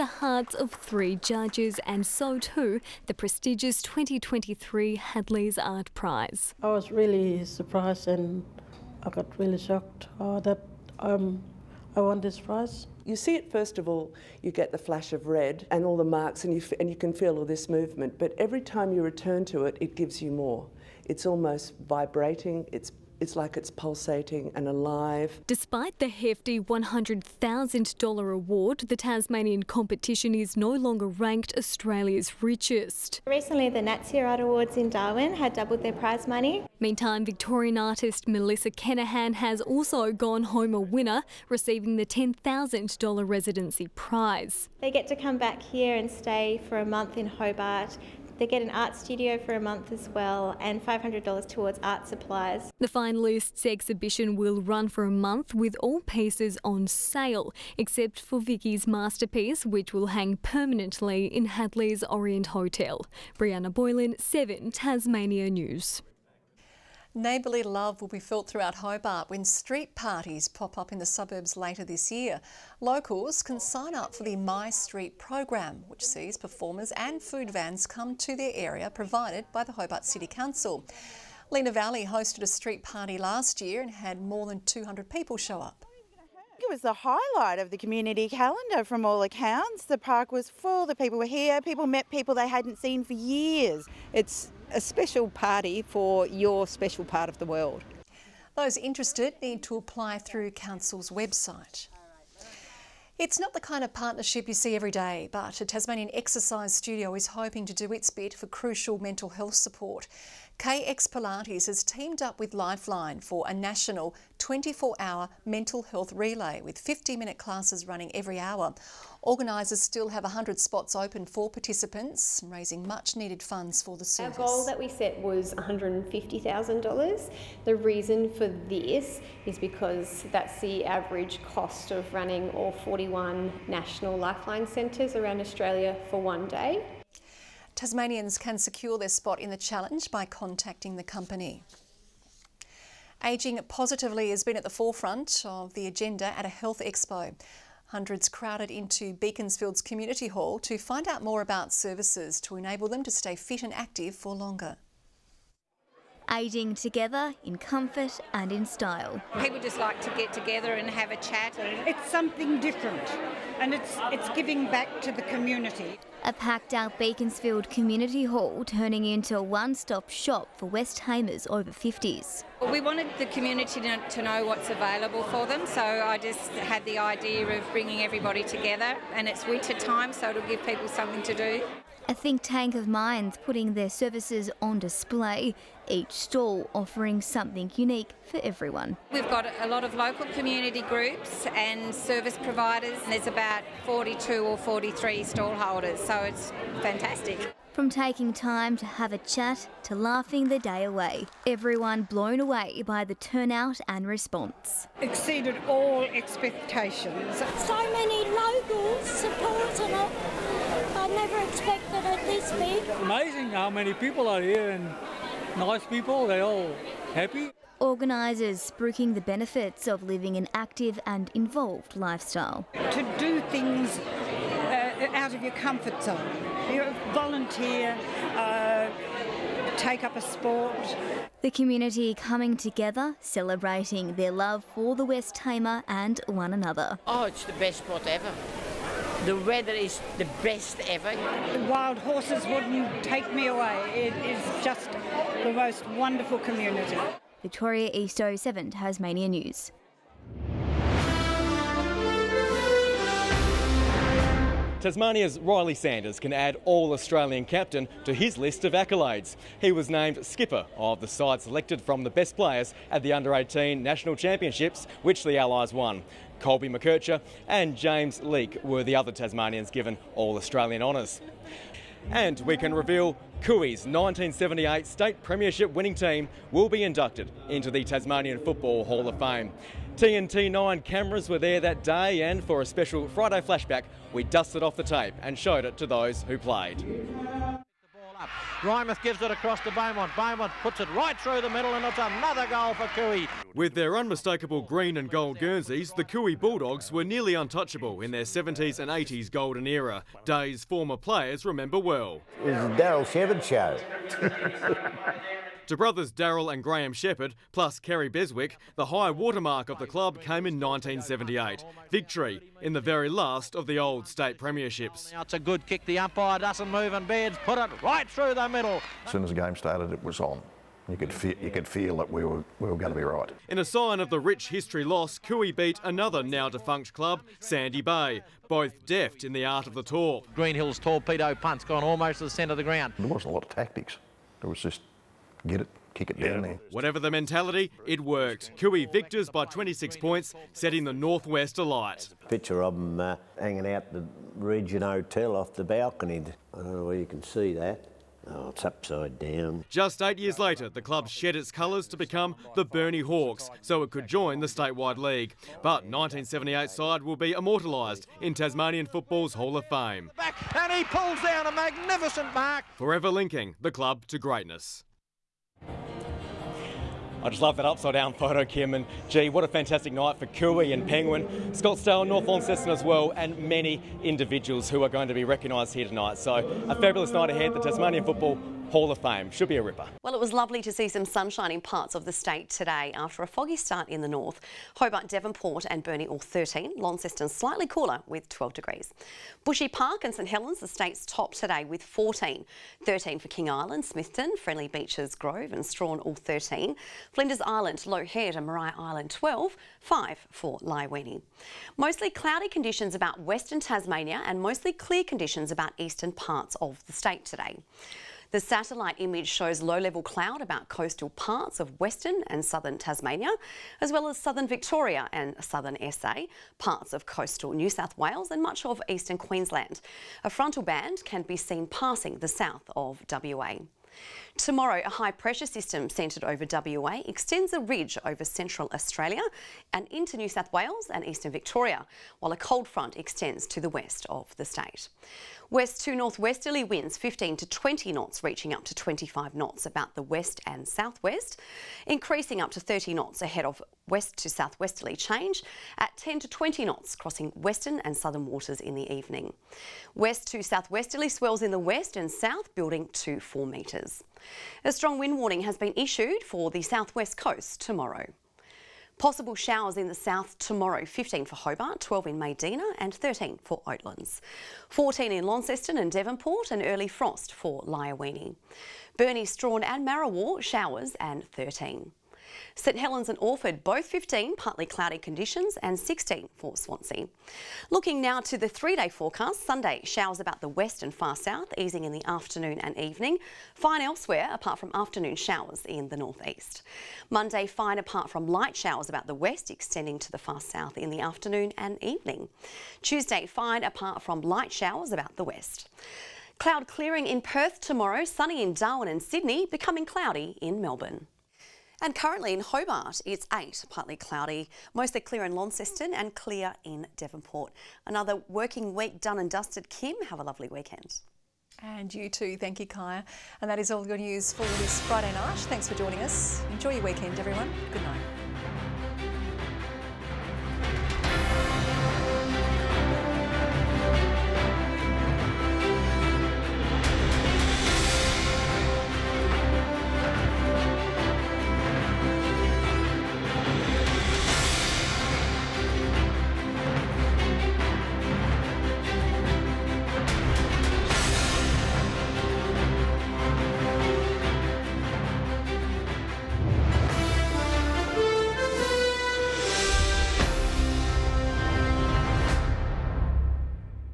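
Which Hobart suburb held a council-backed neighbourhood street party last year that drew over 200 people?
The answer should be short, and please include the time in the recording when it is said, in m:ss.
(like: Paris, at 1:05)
Lenah Valley, at 1:21.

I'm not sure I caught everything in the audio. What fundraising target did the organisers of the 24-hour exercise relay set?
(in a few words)
$150,000.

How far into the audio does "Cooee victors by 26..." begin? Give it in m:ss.
5:38.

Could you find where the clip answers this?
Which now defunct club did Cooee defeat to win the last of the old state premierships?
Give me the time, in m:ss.
5:27.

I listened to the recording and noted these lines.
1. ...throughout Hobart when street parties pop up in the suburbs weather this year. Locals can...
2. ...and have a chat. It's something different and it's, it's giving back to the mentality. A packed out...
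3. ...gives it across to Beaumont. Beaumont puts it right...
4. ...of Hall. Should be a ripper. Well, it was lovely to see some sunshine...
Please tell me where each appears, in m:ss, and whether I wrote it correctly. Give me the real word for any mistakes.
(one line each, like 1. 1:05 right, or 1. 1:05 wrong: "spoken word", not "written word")
1. 1:08 wrong: "later", not "weather"
2. 2:40 wrong: "community", not "mentality"
3. 4:49 right
4. 6:18 wrong: "Fame", not "Hall".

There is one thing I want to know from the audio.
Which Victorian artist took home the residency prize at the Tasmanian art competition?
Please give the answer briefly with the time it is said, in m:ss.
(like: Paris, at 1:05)
Melissa Kenahan, at 0:38.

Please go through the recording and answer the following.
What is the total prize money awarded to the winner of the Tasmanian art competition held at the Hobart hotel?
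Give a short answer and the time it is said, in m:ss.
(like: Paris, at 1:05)
$100,000, at 0:26.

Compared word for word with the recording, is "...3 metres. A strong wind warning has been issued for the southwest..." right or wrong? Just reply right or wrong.
wrong.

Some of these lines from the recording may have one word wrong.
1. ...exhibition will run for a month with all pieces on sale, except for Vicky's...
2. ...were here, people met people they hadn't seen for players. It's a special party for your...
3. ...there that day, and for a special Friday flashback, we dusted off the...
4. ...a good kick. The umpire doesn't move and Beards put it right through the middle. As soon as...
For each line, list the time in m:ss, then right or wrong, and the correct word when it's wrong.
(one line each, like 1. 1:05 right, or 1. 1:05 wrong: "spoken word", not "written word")
1. 0:53 right
2. 1:31 wrong: "years", not "players"
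3. 4:41 right
4. 5:15 right.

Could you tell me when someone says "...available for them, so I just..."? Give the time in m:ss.
2:54.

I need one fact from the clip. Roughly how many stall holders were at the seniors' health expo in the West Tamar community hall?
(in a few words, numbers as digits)
42 or 43.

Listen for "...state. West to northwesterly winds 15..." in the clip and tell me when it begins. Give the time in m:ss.
7:14.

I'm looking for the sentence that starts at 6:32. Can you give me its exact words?
13 for King Island, Smithton, Friendly Beaches, Grove and Strahan all 13.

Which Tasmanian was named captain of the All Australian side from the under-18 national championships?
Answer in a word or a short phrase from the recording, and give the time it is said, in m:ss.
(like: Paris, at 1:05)
Riley Sanders, at 4:15.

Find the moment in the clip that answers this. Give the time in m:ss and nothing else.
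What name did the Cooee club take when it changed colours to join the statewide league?
5:52.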